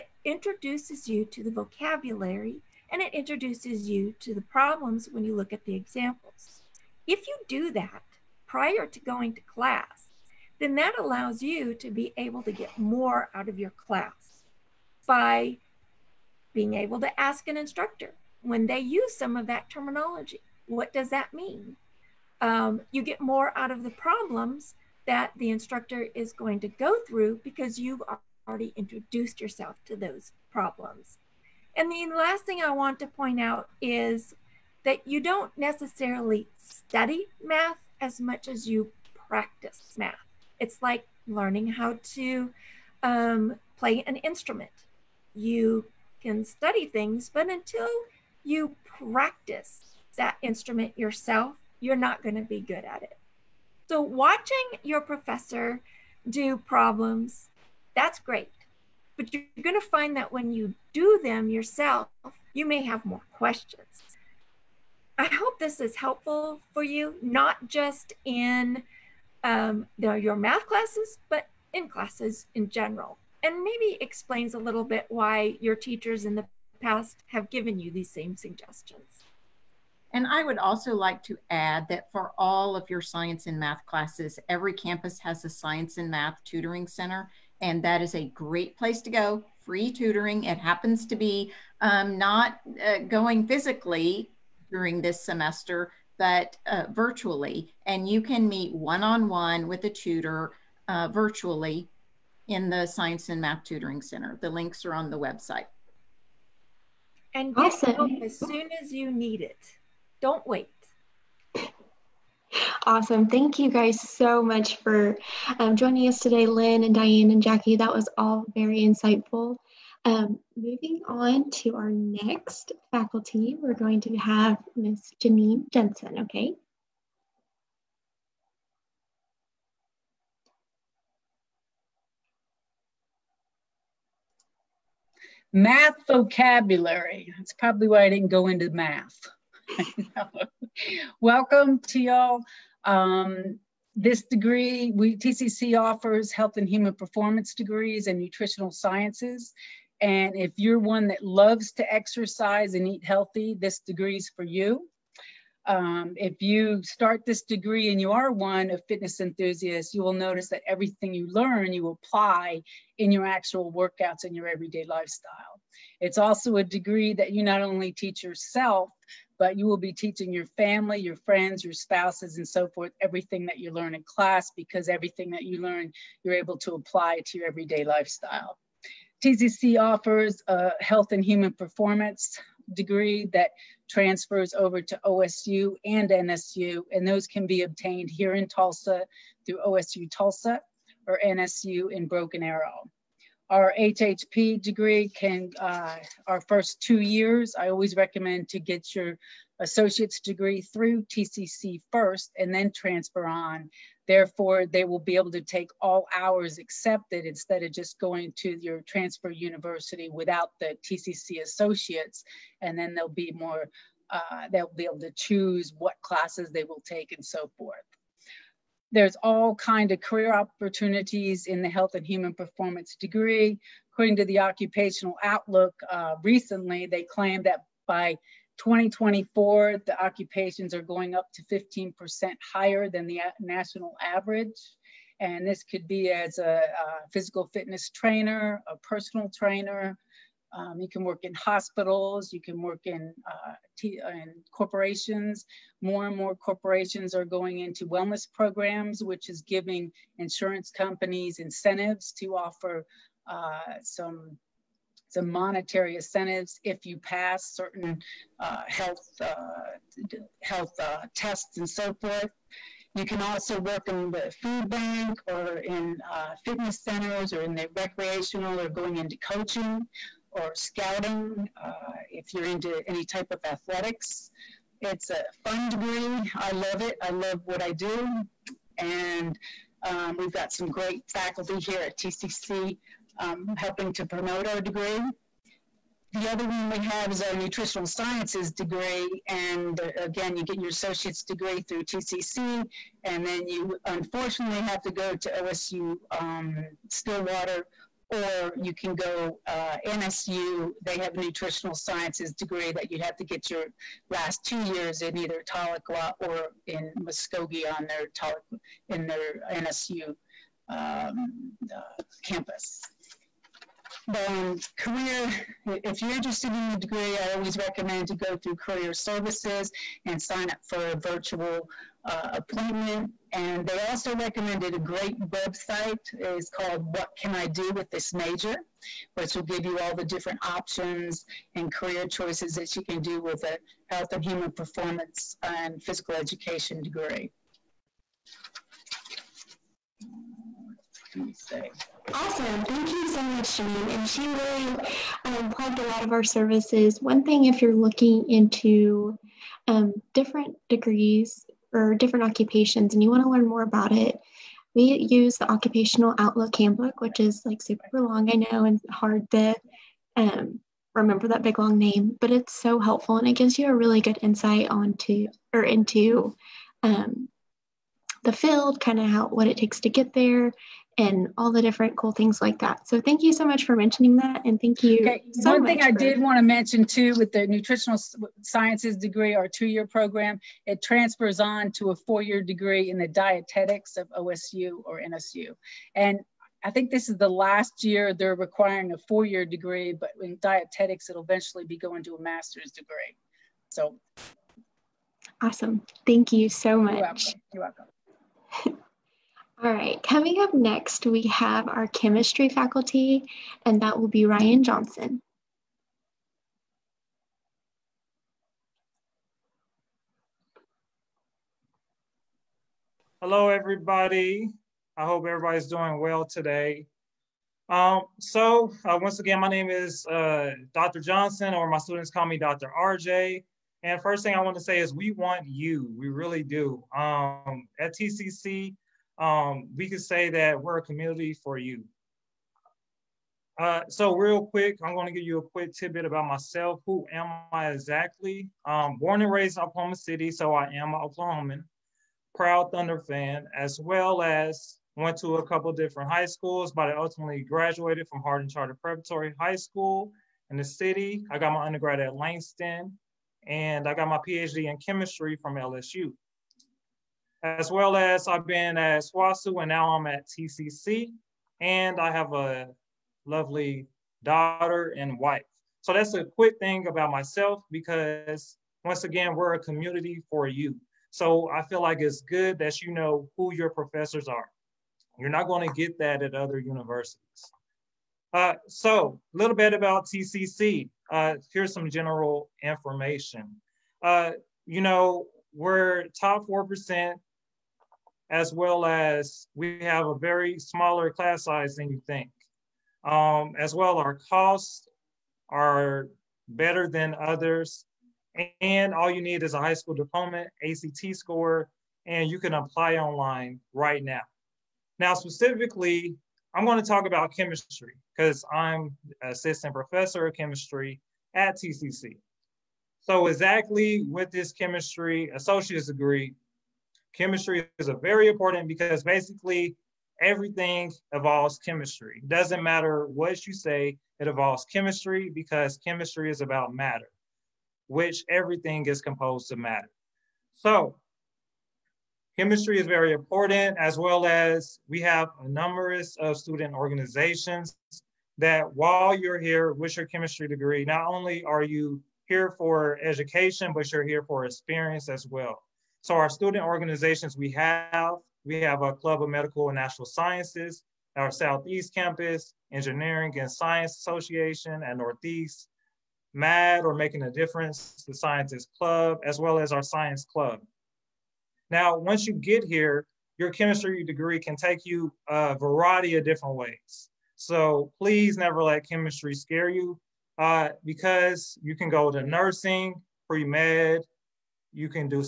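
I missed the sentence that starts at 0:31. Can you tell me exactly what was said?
And the last thing I want to point out is that you don't necessarily study math as much as you practice math.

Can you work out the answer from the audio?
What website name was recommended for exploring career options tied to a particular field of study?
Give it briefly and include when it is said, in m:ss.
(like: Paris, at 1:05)
What Can I Do with This Major, at 5:26.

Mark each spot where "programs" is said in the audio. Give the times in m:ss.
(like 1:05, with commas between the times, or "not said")
4:08, 6:19.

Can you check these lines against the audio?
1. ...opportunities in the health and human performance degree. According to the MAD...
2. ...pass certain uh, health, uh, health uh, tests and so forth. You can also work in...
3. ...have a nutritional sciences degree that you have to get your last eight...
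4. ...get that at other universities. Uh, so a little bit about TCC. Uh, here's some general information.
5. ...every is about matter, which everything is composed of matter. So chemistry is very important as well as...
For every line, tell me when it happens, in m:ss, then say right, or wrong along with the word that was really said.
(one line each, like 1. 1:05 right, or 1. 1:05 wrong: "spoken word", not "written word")
1. 3:40 wrong: "Occupational", not "MAD"
2. 4:16 right
3. 5:00 wrong: "two", not "eight"
4. 7:55 right
5. 8:45 wrong: "chemistry", not "every".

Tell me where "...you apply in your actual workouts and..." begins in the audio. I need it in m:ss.
2:41.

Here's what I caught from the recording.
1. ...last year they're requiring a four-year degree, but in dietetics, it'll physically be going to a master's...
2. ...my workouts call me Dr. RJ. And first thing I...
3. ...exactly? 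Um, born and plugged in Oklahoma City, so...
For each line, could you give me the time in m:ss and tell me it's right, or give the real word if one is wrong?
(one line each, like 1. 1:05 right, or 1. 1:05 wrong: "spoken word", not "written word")
1. 6:27 wrong: "eventually", not "physically"
2. 7:01 wrong: "students", not "workouts"
3. 7:17 wrong: "raised", not "plugged".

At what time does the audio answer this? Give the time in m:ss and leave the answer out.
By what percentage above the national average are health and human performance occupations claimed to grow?
3:51.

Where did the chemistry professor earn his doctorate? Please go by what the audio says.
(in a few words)
LSU.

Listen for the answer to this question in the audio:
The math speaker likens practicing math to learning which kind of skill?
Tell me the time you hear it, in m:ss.
0:43.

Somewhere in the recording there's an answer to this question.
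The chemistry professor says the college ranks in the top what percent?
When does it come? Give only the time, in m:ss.
8:06.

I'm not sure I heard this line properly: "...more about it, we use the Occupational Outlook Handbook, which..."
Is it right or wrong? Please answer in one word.
right.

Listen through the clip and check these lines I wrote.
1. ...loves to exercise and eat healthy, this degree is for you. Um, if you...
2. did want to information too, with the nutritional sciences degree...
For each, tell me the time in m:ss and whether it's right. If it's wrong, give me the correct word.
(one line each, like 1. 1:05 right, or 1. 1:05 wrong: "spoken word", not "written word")
1. 2:31 right
2. 6:15 wrong: "mention", not "information".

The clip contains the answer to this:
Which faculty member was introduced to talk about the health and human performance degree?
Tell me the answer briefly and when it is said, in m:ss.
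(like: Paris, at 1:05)
Janine Jensen, at 2:05.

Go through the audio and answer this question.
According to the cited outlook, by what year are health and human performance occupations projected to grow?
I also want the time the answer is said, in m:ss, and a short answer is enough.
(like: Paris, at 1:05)
2024, at 3:48.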